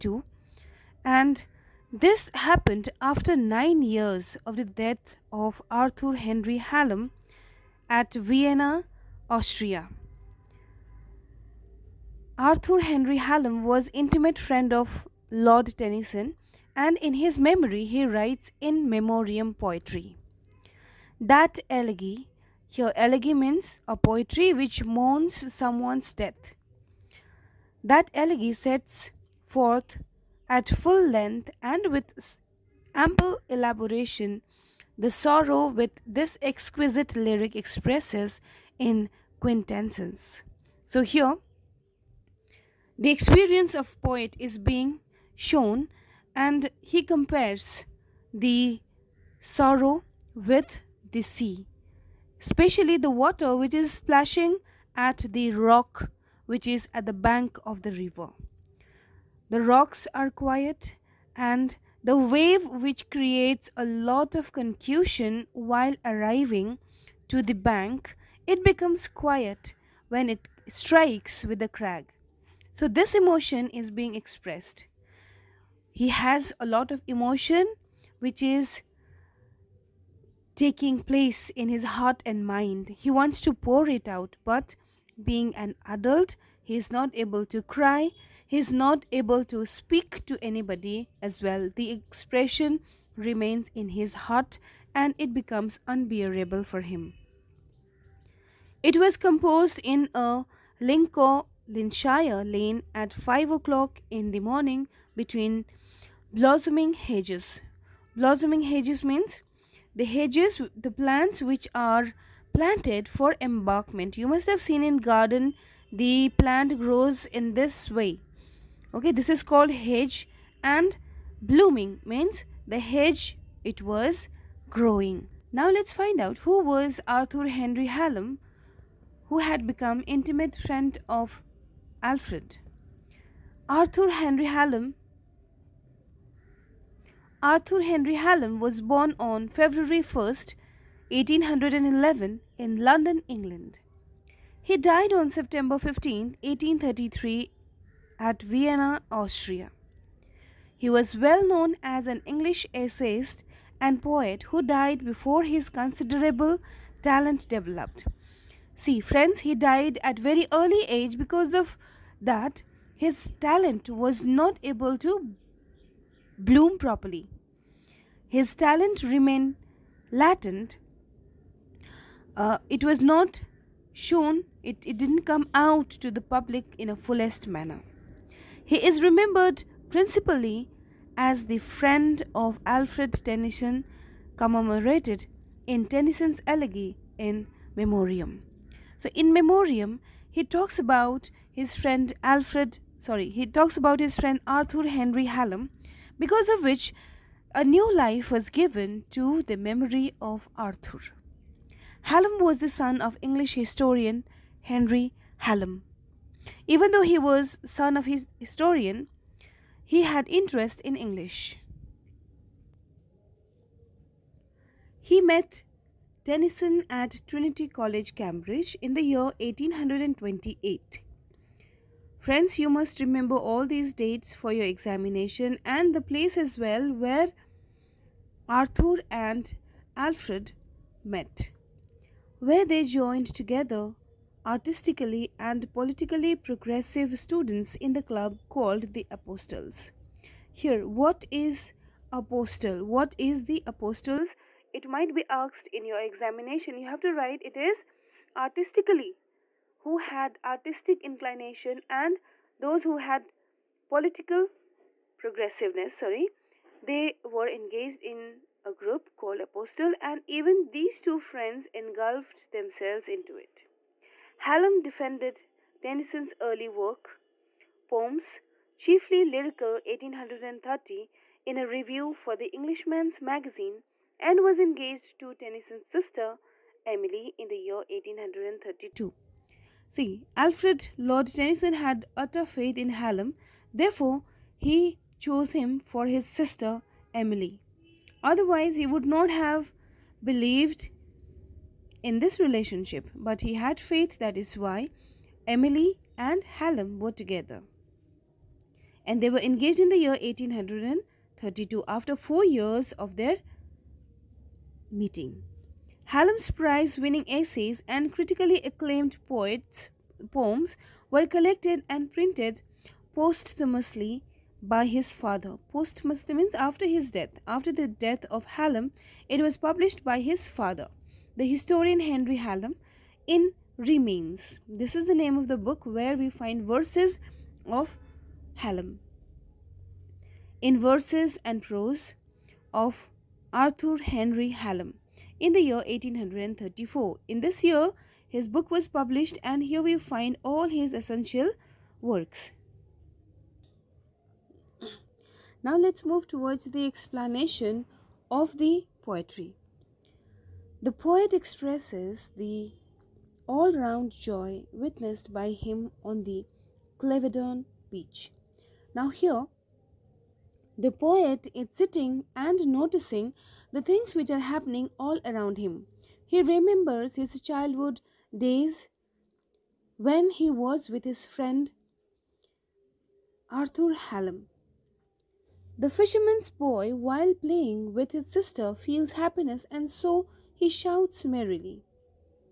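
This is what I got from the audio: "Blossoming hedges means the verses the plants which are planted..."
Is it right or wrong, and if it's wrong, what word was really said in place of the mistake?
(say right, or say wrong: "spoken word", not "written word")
wrong: "hedges", not "verses".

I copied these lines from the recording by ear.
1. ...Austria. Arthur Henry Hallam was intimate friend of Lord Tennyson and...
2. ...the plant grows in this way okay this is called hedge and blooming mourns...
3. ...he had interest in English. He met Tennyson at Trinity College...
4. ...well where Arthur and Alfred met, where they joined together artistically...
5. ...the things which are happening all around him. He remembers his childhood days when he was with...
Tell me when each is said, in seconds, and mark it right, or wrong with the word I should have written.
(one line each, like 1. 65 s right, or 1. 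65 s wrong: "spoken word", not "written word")
1. 9 s right
2. 116 s wrong: "means", not "mourns"
3. 209 s right
4. 226 s right
5. 363 s right.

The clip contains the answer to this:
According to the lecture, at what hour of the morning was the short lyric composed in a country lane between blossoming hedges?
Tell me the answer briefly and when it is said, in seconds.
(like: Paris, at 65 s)
5 o'clock, at 103 s.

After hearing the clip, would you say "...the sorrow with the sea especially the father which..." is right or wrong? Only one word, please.
wrong.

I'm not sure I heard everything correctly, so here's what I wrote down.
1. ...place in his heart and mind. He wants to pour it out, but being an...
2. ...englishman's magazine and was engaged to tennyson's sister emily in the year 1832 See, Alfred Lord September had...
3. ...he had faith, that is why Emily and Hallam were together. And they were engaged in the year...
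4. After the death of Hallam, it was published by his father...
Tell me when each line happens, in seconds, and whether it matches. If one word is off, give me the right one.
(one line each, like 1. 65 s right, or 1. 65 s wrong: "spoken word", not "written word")
1. 81 s right
2. 272 s wrong: "Tennyson", not "September"
3. 293 s right
4. 317 s right.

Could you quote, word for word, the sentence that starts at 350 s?
The poet expresses the all-round joy witnessed by him on the Clevedon beach.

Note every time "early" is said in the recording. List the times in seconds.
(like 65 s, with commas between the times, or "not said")
160 s, 266 s.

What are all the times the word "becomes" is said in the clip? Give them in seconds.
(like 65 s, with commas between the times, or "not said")
68 s, 95 s, 129 s.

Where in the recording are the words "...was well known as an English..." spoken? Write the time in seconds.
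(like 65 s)
150 s.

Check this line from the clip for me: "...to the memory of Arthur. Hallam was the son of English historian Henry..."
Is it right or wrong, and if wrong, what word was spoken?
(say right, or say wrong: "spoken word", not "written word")
right.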